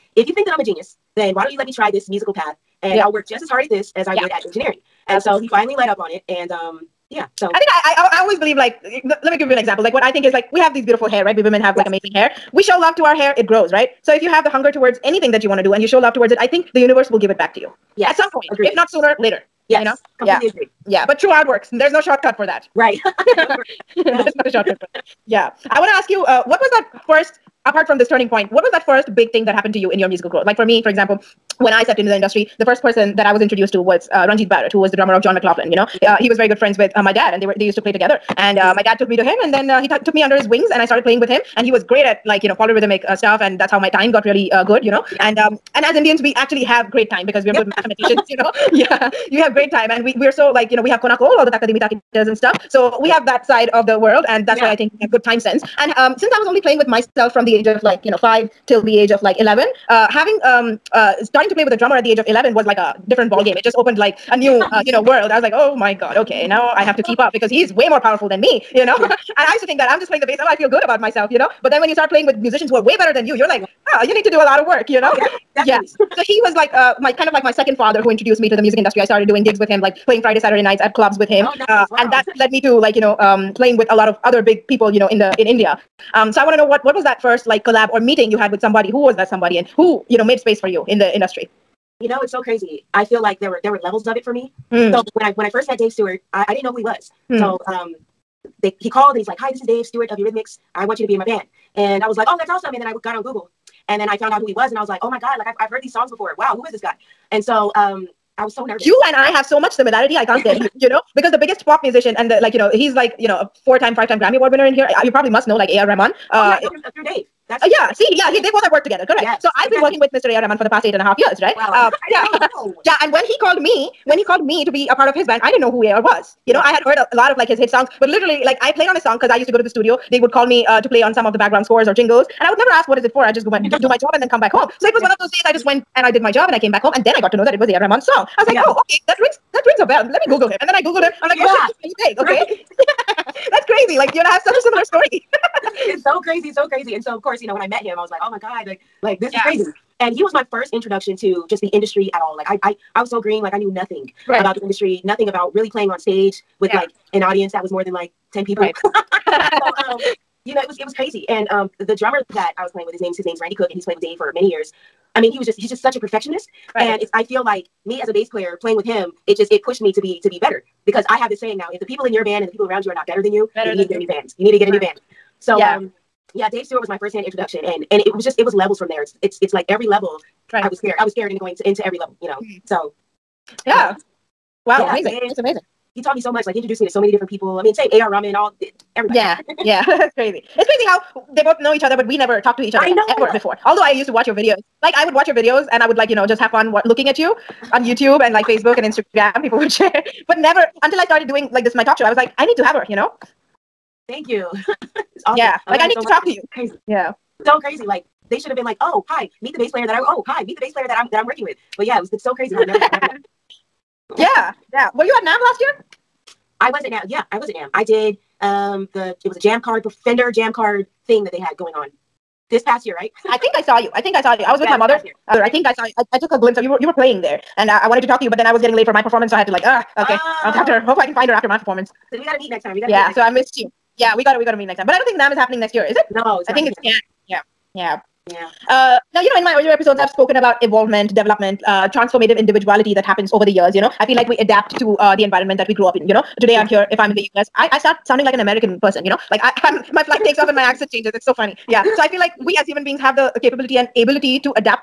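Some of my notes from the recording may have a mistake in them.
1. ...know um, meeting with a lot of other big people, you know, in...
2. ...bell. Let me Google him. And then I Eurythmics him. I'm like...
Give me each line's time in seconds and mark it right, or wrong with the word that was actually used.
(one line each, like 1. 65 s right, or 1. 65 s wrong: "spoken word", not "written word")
1. 83 s wrong: "playing", not "meeting"
2. 139 s wrong: "Googled", not "Eurythmics".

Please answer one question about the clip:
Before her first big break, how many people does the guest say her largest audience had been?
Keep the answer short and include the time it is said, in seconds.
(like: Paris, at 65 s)
10, at 158 s.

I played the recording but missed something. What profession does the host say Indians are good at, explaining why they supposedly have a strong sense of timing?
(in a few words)
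mathematicians.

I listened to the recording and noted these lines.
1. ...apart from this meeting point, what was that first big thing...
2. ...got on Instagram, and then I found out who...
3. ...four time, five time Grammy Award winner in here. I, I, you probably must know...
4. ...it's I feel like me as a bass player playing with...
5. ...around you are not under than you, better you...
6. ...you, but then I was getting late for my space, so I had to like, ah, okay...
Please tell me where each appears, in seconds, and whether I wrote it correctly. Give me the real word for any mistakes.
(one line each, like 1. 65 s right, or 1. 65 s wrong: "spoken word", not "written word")
1. 27 s wrong: "turning", not "meeting"
2. 103 s wrong: "Google", not "Instagram"
3. 113 s right
4. 166 s right
5. 172 s wrong: "better", not "under"
6. 228 s wrong: "performance", not "space".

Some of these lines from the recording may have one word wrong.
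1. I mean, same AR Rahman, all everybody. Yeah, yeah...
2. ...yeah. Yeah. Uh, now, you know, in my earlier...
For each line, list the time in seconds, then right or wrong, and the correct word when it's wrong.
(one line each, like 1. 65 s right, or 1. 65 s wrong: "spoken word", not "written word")
1. 187 s right
2. 237 s right.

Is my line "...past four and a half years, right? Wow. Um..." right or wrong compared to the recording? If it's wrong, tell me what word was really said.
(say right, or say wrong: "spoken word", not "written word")
wrong: "eight", not "four".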